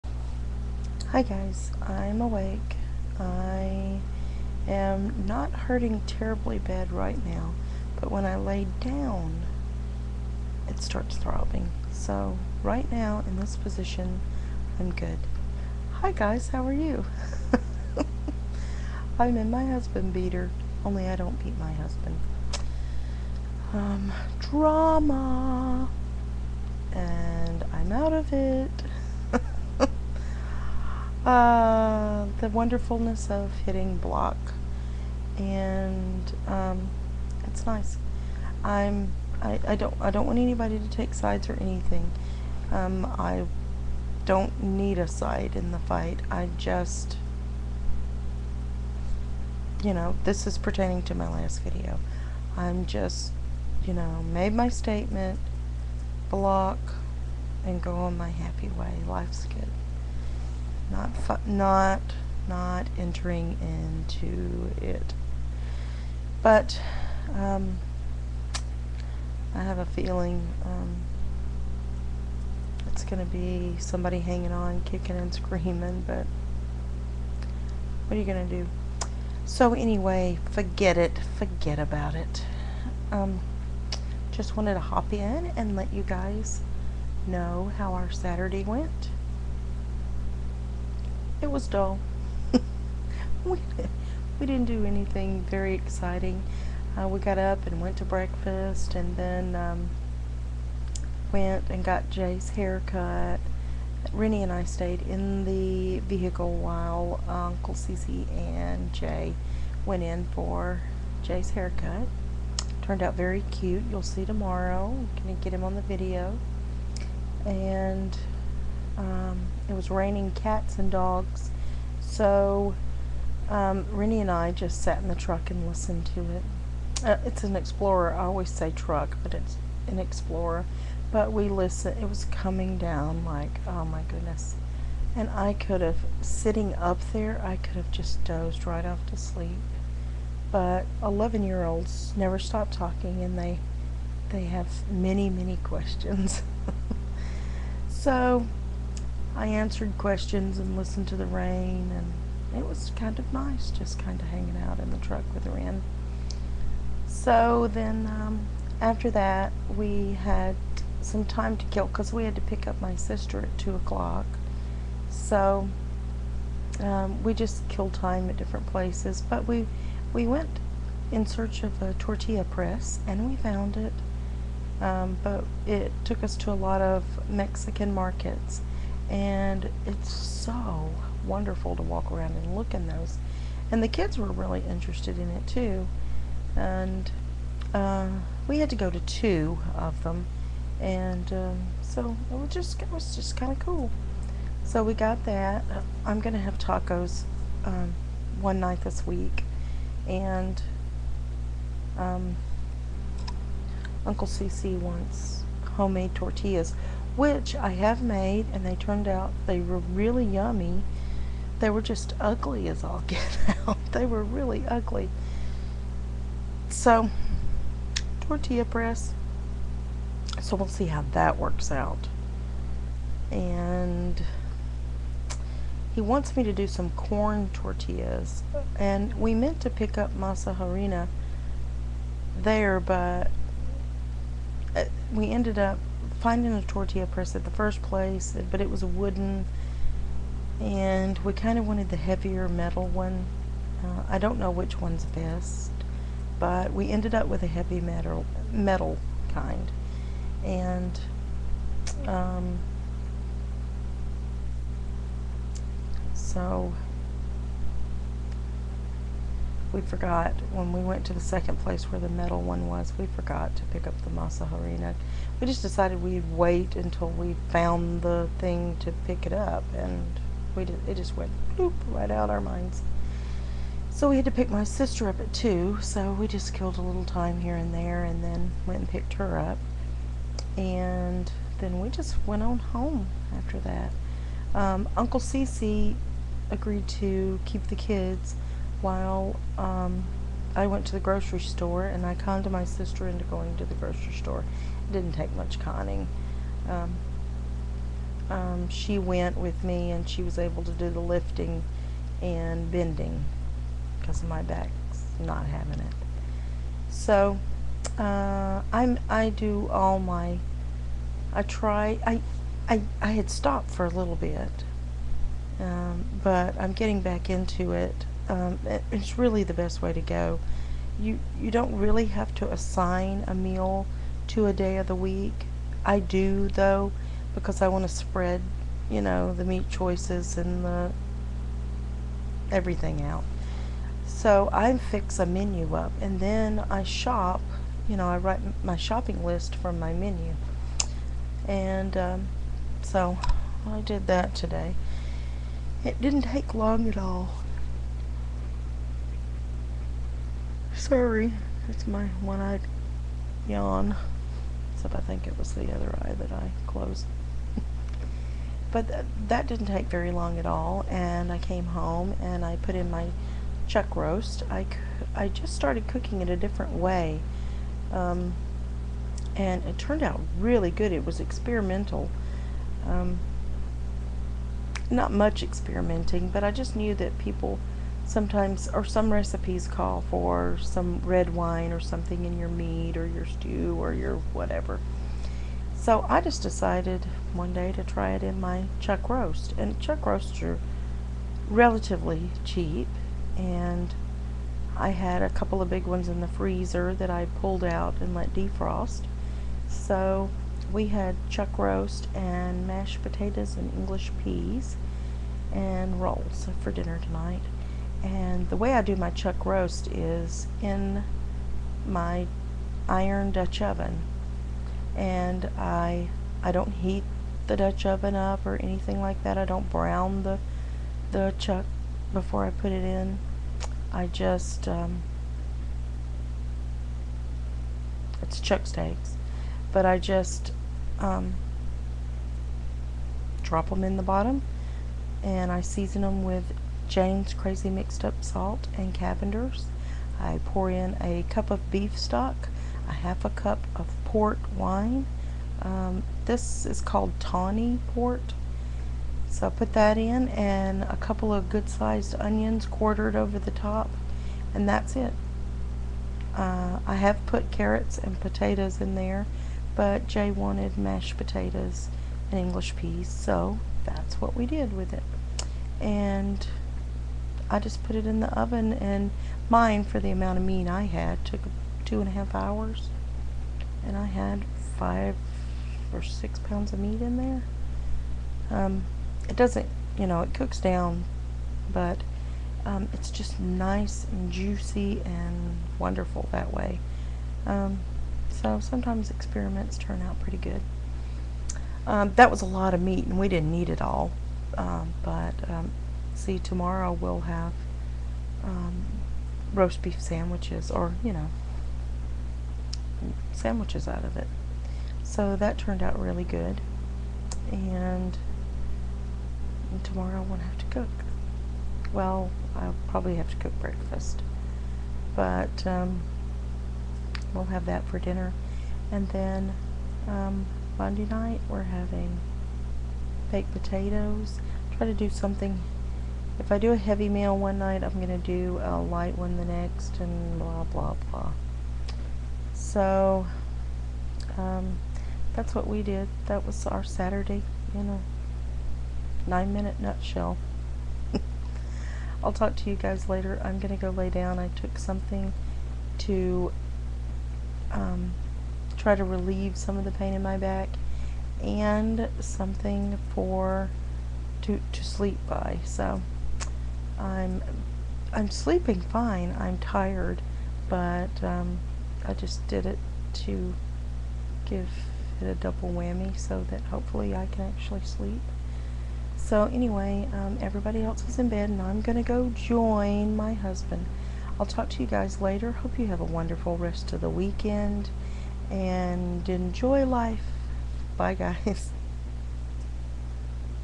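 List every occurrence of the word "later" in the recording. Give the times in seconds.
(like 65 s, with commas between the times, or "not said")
543 s, 575 s.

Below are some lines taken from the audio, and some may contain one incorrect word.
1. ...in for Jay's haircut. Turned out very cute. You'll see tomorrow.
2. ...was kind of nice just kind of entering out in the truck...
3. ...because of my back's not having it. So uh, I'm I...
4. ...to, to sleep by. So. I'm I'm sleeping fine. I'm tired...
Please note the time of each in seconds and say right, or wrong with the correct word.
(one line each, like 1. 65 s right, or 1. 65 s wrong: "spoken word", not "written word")
1. 110 s right
2. 152 s wrong: "hanging", not "entering"
3. 303 s right
4. 554 s right.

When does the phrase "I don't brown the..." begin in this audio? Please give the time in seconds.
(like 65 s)
419 s.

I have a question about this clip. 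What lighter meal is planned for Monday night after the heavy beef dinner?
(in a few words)
baked potatoes.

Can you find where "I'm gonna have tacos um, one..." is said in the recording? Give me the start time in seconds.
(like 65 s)
196 s.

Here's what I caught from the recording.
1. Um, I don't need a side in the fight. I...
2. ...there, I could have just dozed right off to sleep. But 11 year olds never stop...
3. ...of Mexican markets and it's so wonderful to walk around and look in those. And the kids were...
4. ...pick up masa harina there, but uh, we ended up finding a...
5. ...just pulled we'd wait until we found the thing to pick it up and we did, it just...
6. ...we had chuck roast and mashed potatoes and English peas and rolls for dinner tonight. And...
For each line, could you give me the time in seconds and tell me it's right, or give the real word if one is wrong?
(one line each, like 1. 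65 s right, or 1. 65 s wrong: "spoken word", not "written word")
1. 42 s right
2. 137 s right
3. 176 s right
4. 229 s right
5. 265 s wrong: "decided", not "pulled"
6. 400 s right.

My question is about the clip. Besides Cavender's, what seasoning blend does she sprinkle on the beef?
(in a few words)
Jane's Krazy Mixed Up Salt.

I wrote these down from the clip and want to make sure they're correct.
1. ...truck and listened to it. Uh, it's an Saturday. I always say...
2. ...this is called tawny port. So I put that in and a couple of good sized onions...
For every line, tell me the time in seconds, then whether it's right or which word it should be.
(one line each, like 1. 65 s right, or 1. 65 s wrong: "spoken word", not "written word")
1. 125 s wrong: "Explorer", not "Saturday"
2. 446 s right.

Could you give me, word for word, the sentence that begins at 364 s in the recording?
I, I just started cooking it a different way.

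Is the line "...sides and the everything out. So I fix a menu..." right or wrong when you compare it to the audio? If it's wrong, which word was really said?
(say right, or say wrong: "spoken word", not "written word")
wrong: "choices", not "sides".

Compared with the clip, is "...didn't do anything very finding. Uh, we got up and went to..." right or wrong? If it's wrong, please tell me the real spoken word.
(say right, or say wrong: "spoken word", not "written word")
wrong: "exciting", not "finding".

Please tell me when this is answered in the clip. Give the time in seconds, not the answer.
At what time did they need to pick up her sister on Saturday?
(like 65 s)
163 s.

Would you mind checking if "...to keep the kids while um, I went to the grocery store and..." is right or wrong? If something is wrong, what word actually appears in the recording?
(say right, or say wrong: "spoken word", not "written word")
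right.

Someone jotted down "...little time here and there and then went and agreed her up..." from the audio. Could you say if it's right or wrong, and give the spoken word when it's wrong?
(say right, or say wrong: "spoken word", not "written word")
wrong: "picked", not "agreed".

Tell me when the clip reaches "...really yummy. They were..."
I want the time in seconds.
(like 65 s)
209 s.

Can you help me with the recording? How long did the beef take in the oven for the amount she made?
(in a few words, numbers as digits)
2.5 hours.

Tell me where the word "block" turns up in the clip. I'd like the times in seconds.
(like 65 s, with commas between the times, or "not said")
33 s, 56 s.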